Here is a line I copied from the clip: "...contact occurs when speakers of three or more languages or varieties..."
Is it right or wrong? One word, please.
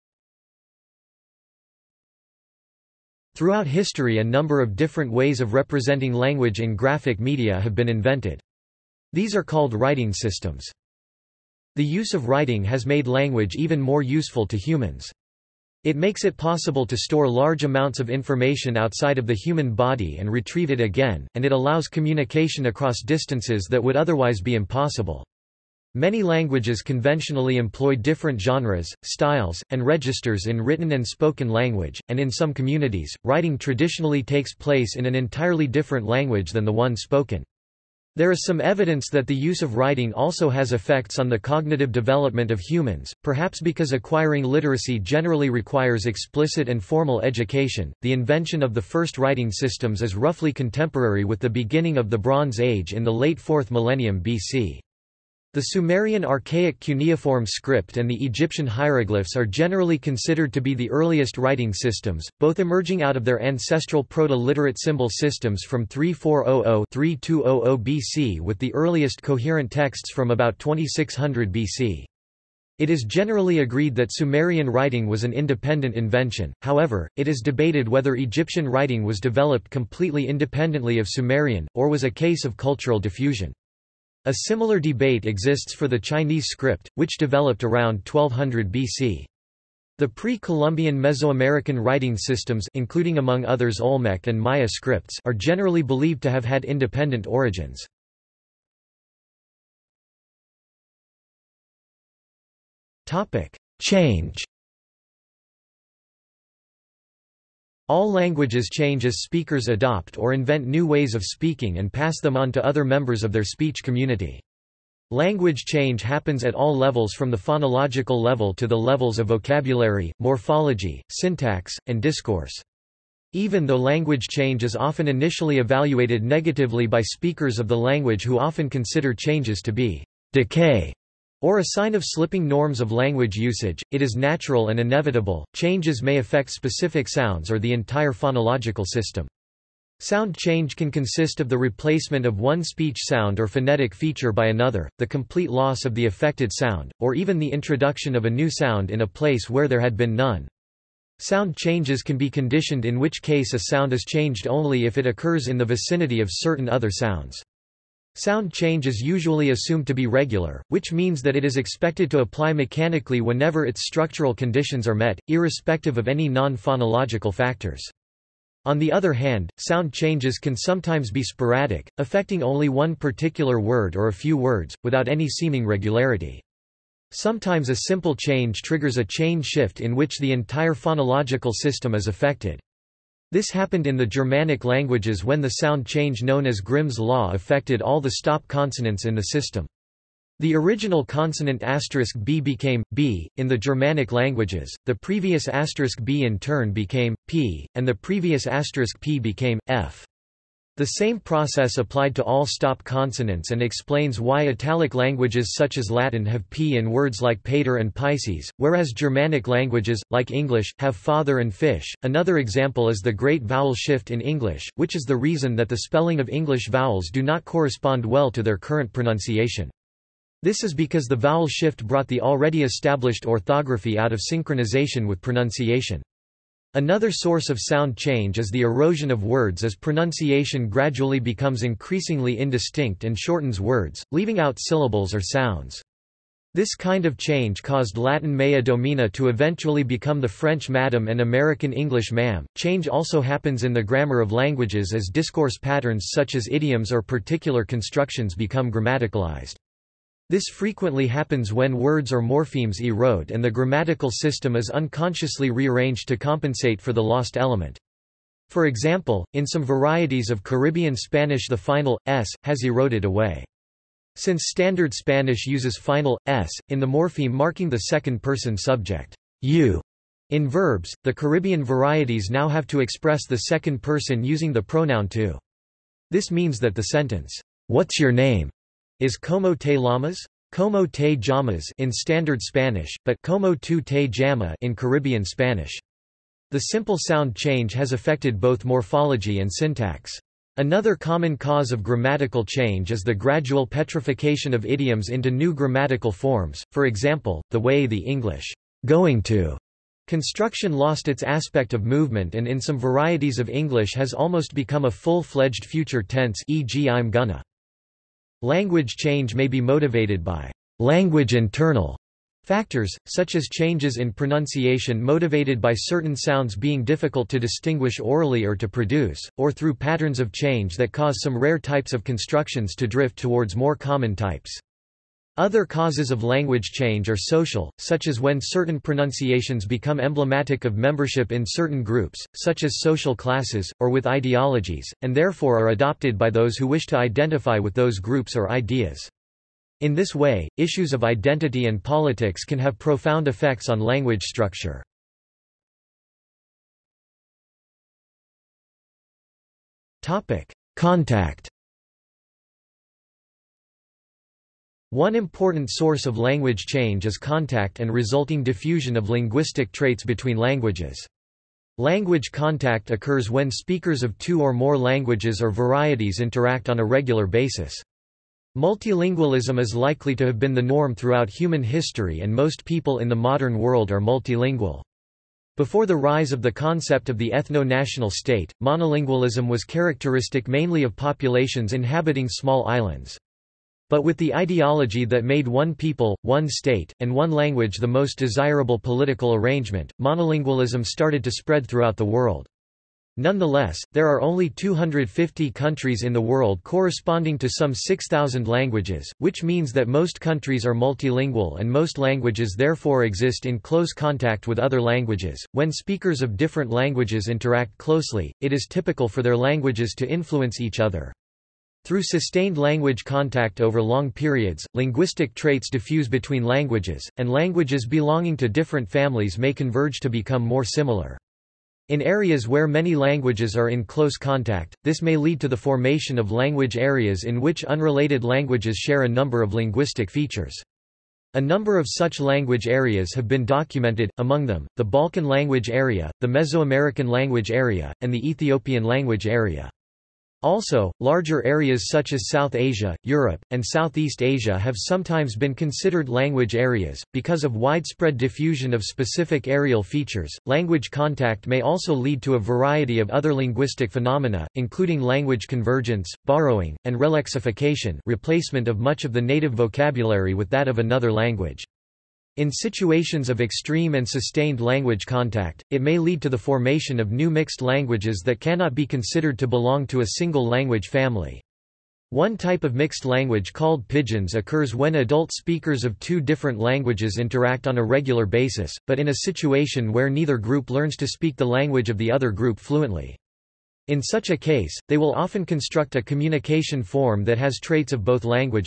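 wrong.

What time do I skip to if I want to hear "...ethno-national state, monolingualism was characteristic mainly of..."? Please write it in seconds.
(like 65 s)
377 s.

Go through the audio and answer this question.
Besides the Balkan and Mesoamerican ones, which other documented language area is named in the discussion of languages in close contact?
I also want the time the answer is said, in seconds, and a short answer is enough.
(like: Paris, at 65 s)
Ethiopian language area, at 438 s.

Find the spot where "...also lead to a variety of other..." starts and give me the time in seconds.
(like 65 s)
451 s.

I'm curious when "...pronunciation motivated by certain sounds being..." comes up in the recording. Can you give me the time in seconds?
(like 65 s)
314 s.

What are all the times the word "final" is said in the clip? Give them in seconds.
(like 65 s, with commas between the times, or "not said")
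261 s, 265 s.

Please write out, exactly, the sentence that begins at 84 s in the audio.
A similar debate exists for the Chinese script, which developed around 1200 BC.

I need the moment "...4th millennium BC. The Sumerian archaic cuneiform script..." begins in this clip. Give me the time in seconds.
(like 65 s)
53 s.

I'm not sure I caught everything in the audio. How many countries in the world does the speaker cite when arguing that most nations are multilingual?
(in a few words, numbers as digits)
250.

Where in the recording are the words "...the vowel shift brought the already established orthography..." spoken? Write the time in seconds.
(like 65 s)
221 s.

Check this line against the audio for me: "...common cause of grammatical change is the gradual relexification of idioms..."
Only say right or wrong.
wrong.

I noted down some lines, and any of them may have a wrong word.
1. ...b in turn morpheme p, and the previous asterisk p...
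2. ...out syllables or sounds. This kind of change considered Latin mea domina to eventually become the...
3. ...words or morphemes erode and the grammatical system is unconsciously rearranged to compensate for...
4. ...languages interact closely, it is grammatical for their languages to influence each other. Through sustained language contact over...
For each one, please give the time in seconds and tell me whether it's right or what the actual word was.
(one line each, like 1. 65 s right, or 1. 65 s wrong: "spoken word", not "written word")
1. 196 s wrong: "became", not "morpheme"
2. 234 s wrong: "caused", not "considered"
3. 251 s right
4. 406 s wrong: "typical", not "grammatical".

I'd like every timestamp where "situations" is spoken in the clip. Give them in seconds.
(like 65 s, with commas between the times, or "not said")
462 s, 479 s.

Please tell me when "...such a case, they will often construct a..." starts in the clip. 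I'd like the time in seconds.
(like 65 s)
484 s.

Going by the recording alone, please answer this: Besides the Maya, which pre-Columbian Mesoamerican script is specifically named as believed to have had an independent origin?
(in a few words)
Olmec.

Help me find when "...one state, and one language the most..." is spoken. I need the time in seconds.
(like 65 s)
386 s.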